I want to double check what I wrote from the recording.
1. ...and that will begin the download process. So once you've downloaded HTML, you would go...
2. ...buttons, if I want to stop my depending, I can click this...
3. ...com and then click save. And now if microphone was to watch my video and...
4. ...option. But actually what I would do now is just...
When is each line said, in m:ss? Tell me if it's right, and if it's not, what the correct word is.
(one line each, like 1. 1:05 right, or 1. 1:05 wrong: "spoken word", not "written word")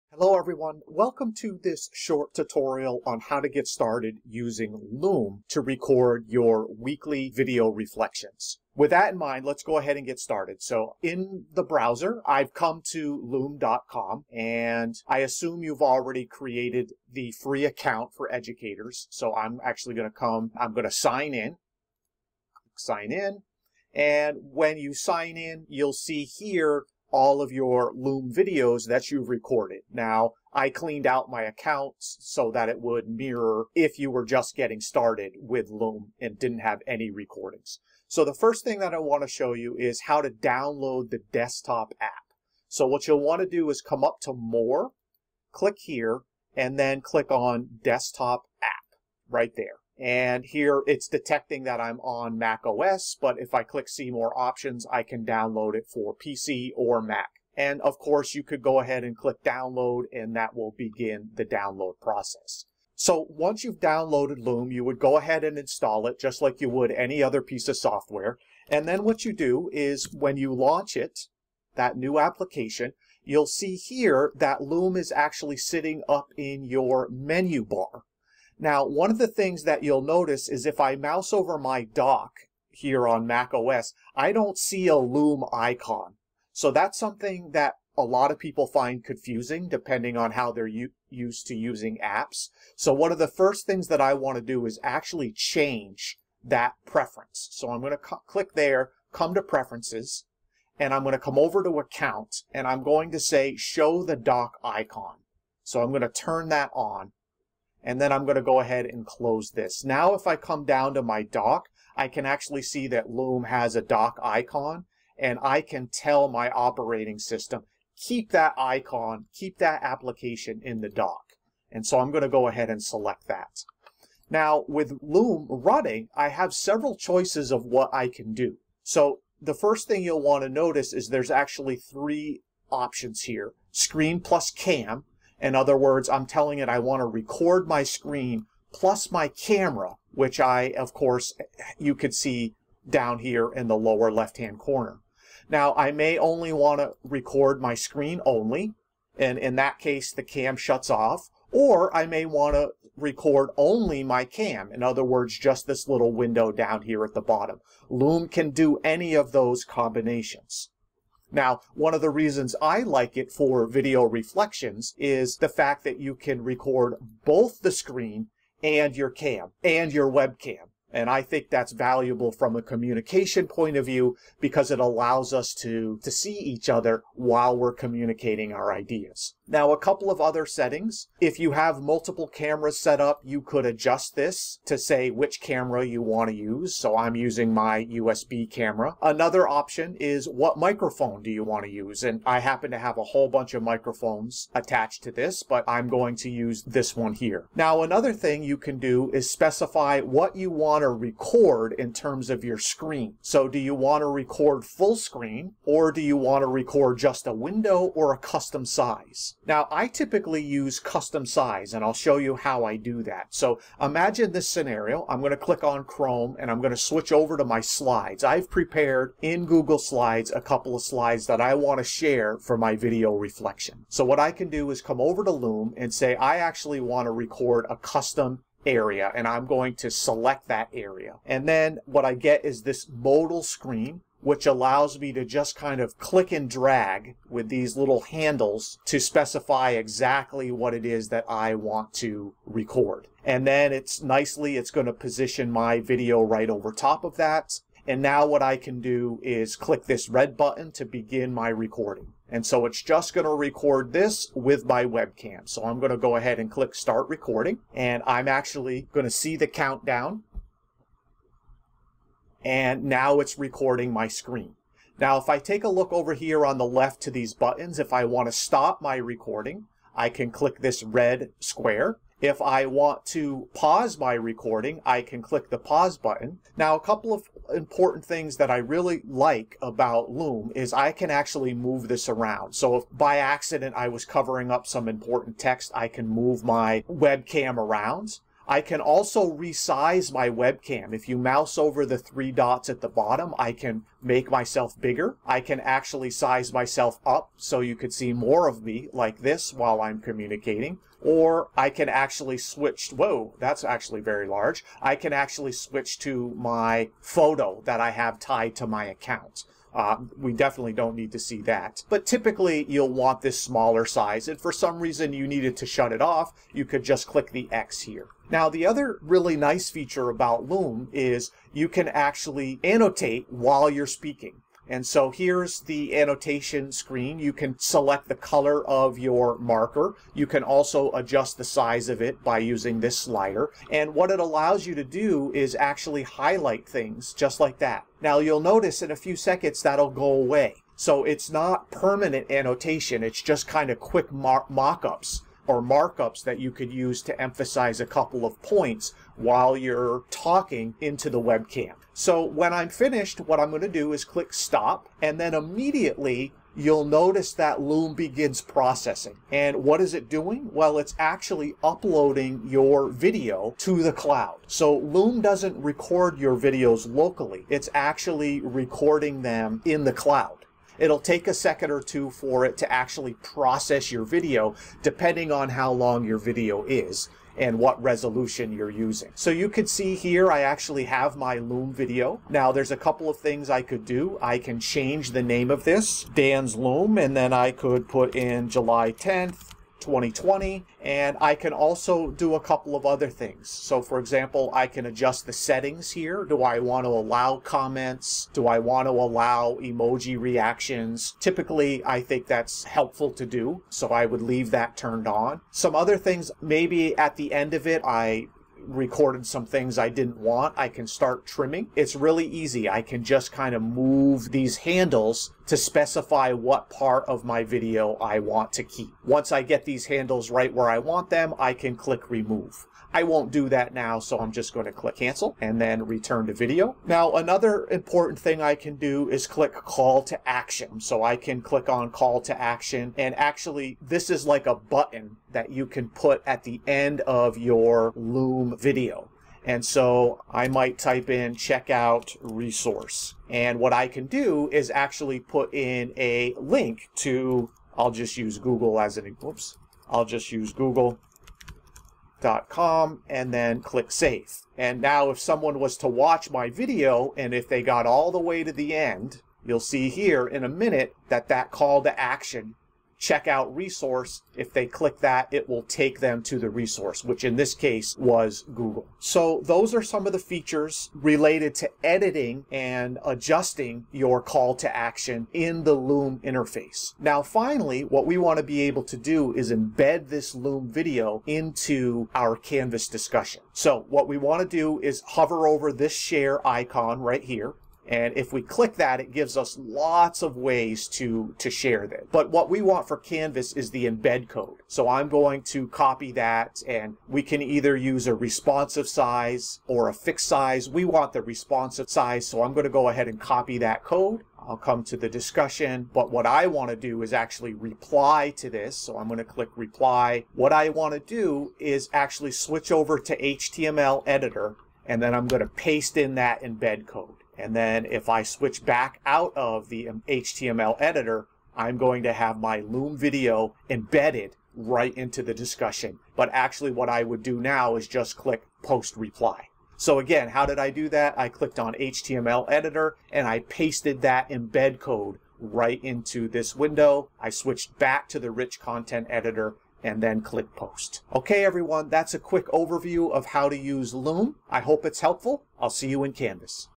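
1. 1:00 wrong: "Loom", not "HTML"
2. 4:27 wrong: "recording", not "depending"
3. 7:32 wrong: "someone", not "microphone"
4. 8:45 wrong: "discussion", not "option".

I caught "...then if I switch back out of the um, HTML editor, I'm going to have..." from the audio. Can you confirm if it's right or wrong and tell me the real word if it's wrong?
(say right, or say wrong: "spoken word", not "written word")
right.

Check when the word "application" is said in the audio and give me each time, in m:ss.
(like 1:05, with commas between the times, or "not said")
1:12, 1:59.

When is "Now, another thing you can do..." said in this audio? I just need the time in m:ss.
3:17.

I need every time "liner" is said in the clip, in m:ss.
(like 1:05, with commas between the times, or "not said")
not said.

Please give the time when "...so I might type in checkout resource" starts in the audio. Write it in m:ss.
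7:19.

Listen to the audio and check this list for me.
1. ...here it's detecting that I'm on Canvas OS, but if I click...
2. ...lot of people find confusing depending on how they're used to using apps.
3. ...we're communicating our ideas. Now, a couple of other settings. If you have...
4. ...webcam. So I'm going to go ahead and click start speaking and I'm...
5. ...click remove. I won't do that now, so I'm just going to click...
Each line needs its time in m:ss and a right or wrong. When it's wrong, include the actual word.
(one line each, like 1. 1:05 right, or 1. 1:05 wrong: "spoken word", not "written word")
1. 0:50 wrong: "Mac", not "Canvas"
2. 1:28 right
3. 2:57 right
4. 4:14 wrong: "recording", not "speaking"
5. 7:01 right.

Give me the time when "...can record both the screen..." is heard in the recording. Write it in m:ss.
2:46.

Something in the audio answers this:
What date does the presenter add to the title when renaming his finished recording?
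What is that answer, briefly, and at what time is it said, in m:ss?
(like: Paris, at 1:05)
July 10th, 2020, at 6:28.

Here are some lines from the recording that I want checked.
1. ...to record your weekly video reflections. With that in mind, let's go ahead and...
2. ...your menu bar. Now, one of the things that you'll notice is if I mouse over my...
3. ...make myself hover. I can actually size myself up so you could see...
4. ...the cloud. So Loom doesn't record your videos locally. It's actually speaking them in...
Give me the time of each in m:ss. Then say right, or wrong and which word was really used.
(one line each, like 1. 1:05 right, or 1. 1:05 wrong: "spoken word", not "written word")
1. 0:05 right
2. 1:16 right
3. 4:54 wrong: "bigger", not "hover"
4. 6:03 wrong: "recording", not "speaking".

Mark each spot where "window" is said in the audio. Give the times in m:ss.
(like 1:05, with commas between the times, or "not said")
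2:36, 3:27, 8:56.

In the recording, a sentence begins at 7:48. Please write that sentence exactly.
So those are some of the features related to editing and adjusting your call to action in the Loom interface.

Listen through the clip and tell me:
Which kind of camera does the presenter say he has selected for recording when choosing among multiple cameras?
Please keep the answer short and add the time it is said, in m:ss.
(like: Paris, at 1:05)
USB camera, at 3:07.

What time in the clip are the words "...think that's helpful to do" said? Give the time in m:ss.
6:42.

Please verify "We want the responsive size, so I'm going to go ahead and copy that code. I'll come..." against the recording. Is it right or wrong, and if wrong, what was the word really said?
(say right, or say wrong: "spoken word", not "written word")
right.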